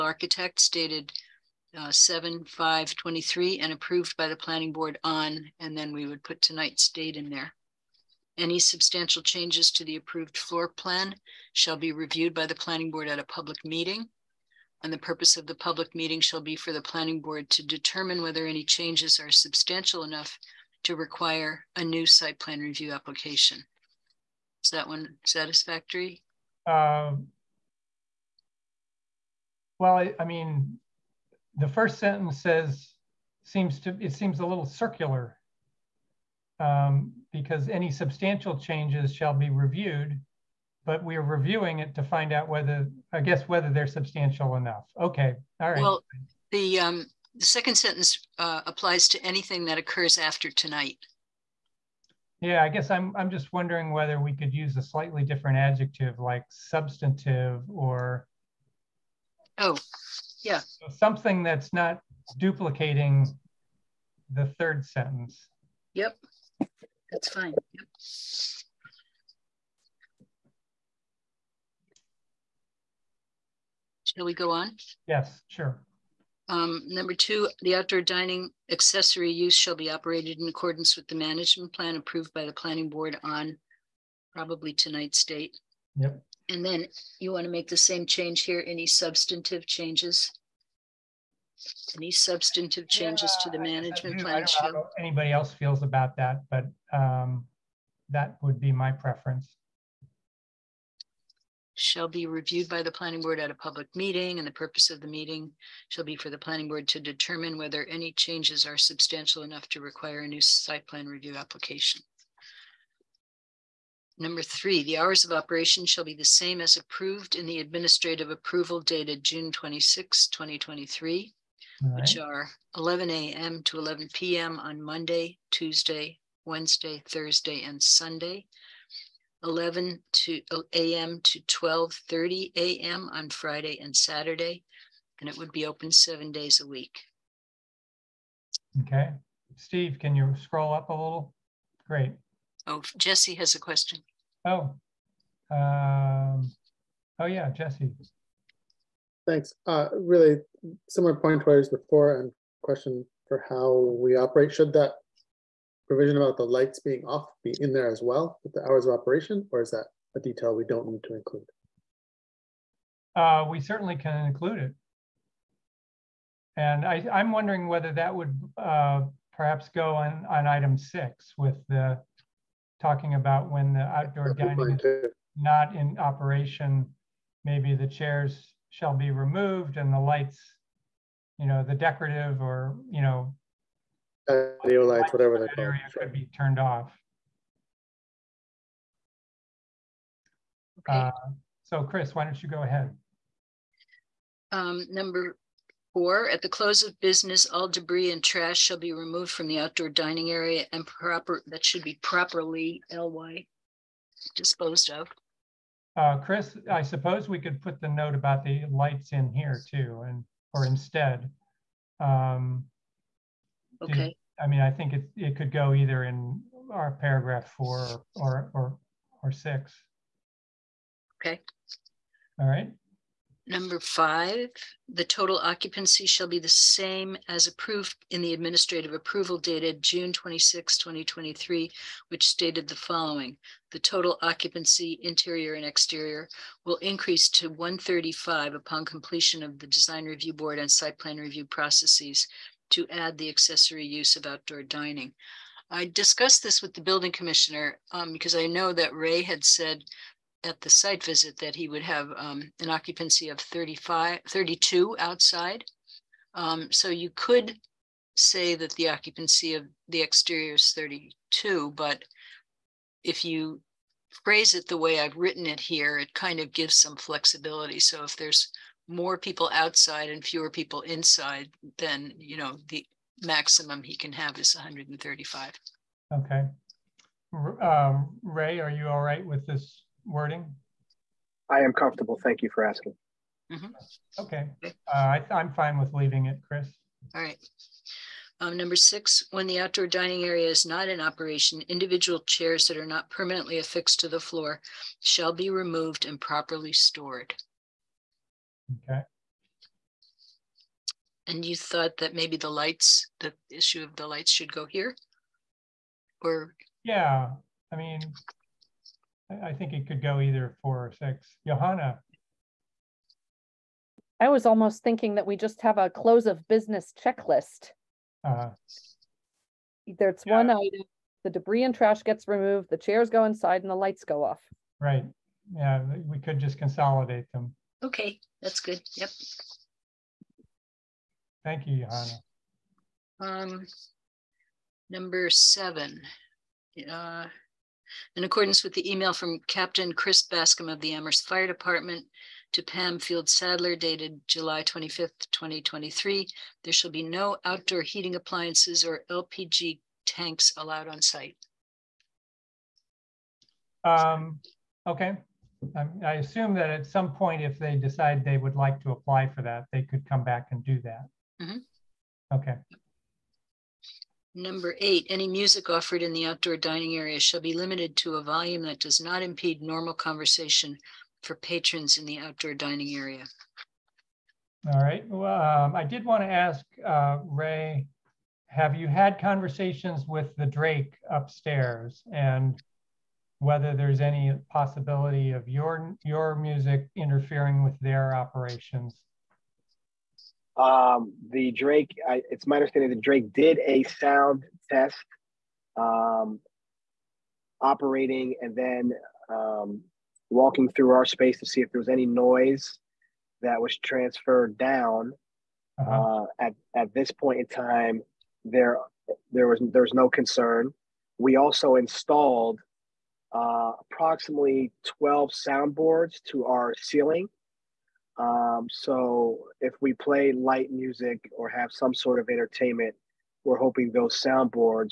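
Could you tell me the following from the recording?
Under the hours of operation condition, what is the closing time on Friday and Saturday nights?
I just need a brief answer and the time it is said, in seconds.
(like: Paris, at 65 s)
12:30 a.m., at 131 s.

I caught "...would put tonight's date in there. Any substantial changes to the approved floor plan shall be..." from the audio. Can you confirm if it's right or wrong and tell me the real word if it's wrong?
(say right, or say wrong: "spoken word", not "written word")
right.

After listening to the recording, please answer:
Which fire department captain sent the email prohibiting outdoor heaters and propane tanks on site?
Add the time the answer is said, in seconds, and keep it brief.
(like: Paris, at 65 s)
Chris Bascom, at 339 s.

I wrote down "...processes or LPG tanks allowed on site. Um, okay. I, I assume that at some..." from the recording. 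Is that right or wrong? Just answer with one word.
wrong.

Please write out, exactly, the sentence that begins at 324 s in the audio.
Right, yeah, we could just consolidate them.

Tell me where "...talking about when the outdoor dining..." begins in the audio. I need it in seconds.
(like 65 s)
172 s.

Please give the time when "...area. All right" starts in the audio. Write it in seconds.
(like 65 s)
372 s.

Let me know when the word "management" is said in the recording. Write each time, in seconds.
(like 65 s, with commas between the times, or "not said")
81 s, 93 s.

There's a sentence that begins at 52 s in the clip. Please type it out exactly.
Yeah, I guess I'm, I'm just wondering whether we could use a slightly different adjective like substantive or.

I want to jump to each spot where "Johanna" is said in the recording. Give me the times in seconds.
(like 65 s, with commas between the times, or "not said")
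311 s, 331 s.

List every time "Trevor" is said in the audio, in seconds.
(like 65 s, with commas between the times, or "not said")
not said.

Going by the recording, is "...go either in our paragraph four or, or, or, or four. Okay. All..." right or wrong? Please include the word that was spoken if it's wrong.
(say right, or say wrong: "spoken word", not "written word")
wrong: "six", not "four".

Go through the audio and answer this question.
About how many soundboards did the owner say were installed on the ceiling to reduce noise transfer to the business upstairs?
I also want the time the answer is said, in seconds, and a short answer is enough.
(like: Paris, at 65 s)
12, at 414 s.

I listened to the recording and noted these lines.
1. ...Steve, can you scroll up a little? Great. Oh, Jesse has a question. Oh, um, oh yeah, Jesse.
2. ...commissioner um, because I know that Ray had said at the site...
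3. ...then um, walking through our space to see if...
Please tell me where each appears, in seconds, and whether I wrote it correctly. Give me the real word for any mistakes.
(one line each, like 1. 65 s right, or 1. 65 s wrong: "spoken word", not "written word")
1. 139 s right
2. 247 s right
3. 398 s right.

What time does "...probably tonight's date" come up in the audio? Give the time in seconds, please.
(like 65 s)
84 s.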